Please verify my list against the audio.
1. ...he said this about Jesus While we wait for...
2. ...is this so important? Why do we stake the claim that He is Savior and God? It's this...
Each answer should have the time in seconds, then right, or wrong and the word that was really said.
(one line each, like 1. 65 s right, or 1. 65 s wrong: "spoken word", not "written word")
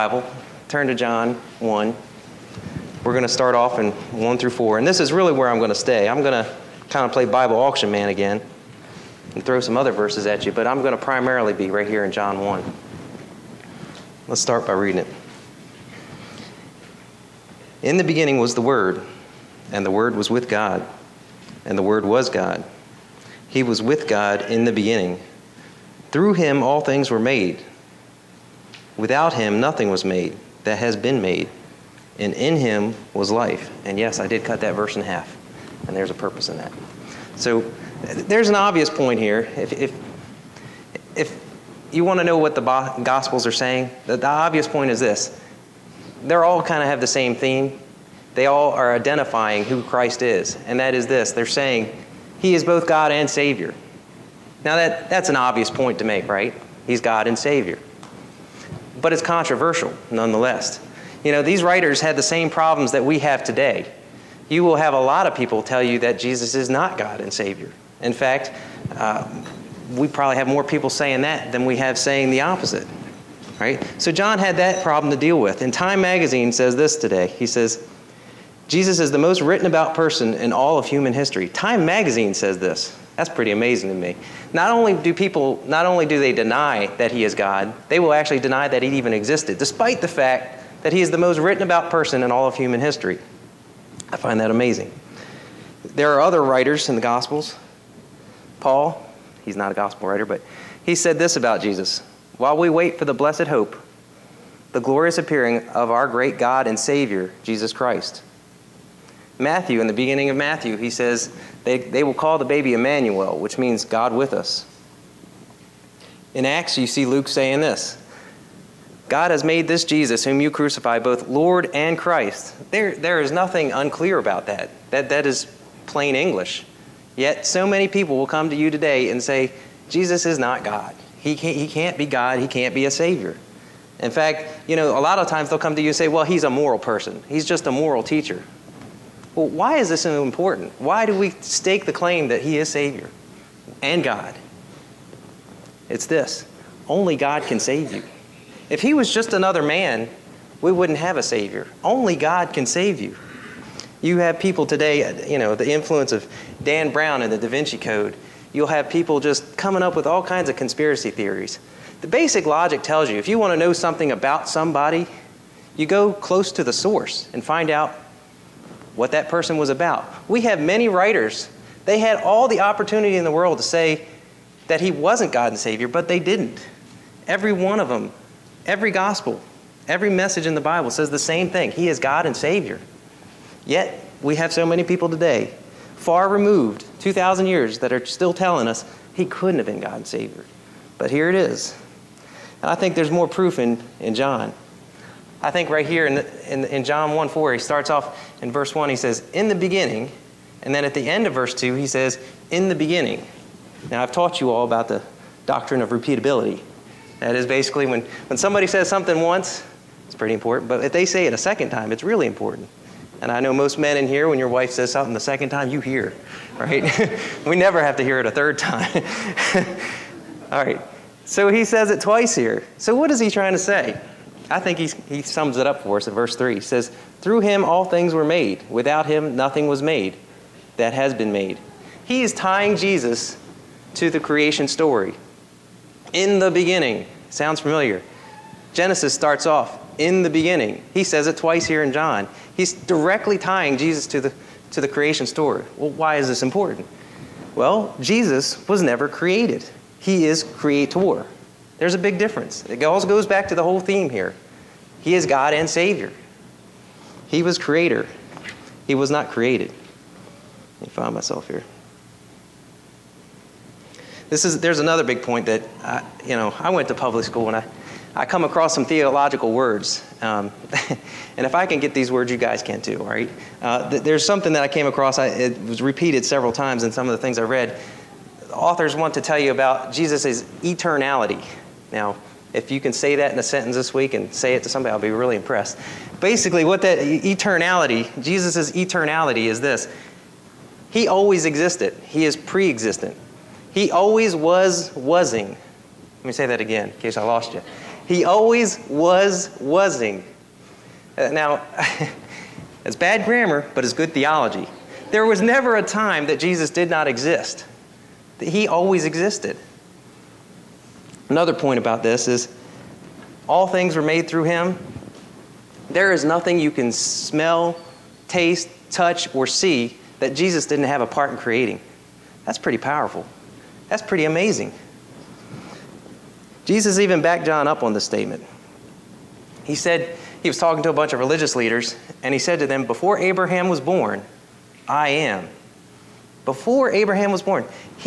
1. 100 s right
2. 139 s right.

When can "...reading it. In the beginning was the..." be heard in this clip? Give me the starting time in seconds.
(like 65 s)
14 s.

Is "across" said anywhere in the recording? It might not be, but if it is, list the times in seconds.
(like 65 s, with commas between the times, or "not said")
268 s, 274 s.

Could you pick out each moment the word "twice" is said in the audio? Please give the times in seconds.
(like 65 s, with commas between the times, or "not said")
221 s, 241 s.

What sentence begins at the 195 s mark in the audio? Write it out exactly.
I think right here in, the, in, in, John 1 4, he starts off in verse 1, he says, In the beginning.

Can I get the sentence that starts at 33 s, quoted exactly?
And yes, I did cut that verse in half.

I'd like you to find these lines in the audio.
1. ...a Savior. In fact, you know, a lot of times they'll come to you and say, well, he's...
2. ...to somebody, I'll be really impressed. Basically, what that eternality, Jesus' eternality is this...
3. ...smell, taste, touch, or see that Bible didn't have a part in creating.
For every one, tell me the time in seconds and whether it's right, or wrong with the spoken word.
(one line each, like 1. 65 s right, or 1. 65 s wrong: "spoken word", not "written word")
1. 132 s right
2. 284 s right
3. 316 s wrong: "Jesus", not "Bible".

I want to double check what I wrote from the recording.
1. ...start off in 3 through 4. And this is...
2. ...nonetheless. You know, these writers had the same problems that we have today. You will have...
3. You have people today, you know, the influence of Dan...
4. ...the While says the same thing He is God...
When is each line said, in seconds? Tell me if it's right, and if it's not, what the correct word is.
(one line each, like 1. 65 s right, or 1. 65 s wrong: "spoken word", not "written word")
1. 3 s wrong: "1", not "3"
2. 60 s right
3. 154 s right
4. 180 s wrong: "Bible", not "While".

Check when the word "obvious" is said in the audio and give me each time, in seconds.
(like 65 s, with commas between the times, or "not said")
38 s, 44 s, 55 s.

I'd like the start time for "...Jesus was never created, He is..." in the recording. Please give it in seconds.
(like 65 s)
247 s.